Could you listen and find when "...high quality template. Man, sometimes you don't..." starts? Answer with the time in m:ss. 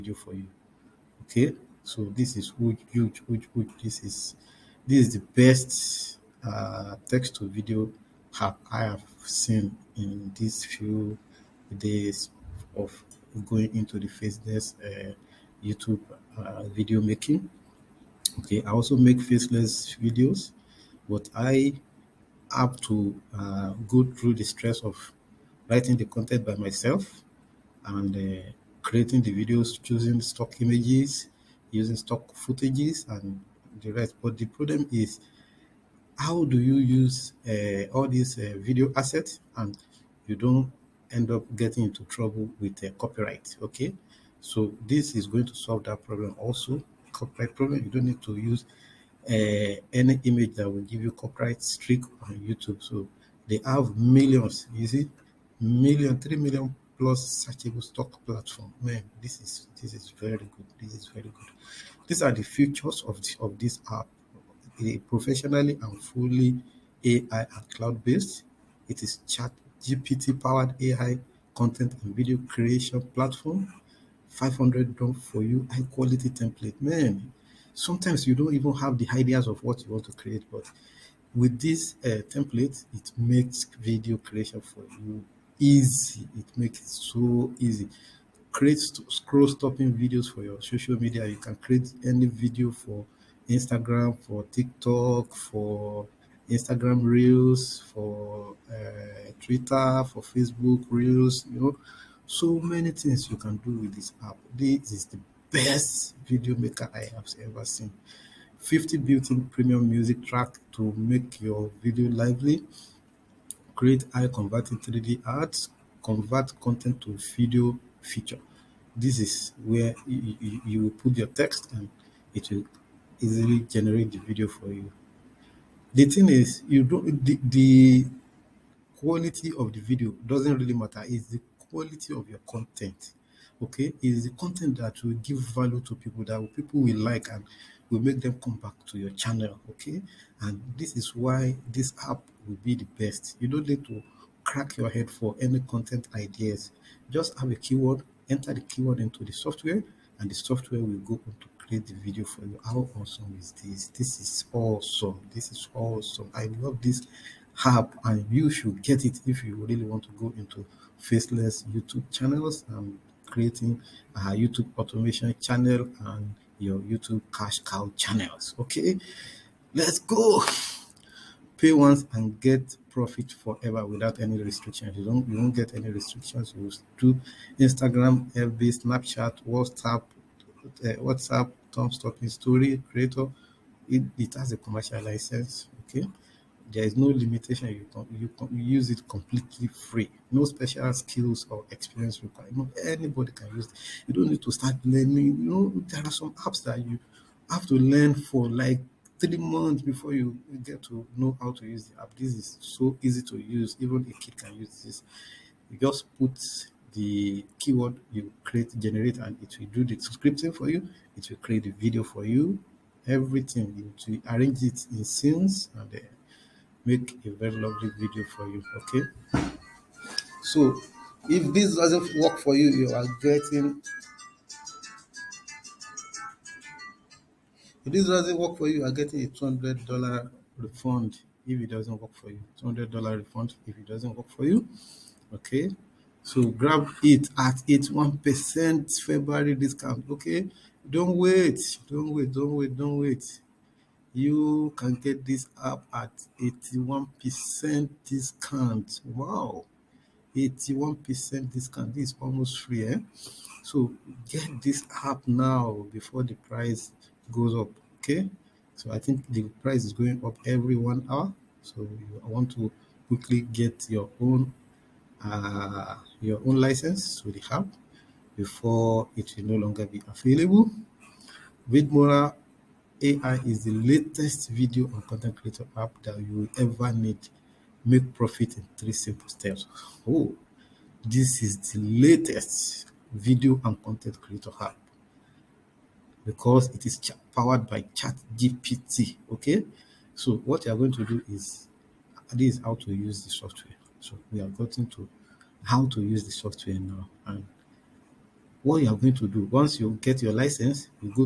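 1:15.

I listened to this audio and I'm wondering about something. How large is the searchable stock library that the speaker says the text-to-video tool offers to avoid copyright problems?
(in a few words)
3 million plus.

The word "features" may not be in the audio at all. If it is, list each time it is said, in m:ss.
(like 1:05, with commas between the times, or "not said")
1:02, 1:57.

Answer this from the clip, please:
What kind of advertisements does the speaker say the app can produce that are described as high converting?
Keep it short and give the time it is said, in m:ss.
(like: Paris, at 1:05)
3D ads, at 1:54.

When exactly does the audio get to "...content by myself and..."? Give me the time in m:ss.
0:26.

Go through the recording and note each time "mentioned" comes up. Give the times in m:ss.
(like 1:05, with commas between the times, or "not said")
not said.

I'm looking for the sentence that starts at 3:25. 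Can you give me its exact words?
You just put the keyword you create, generate, and it will do the scripting for you.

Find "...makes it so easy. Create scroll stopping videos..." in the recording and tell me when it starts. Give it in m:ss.
1:26.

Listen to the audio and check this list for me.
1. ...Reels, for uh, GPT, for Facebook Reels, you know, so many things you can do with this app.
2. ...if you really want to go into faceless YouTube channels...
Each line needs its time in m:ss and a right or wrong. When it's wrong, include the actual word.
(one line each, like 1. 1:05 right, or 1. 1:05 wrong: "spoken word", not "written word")
1. 1:37 wrong: "Twitter", not "GPT"
2. 2:39 right.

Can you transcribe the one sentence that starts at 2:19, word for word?
Okay, and this is why this app will be the best.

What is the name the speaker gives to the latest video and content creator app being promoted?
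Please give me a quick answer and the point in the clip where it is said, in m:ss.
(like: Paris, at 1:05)
Vidmora AI, at 4:31.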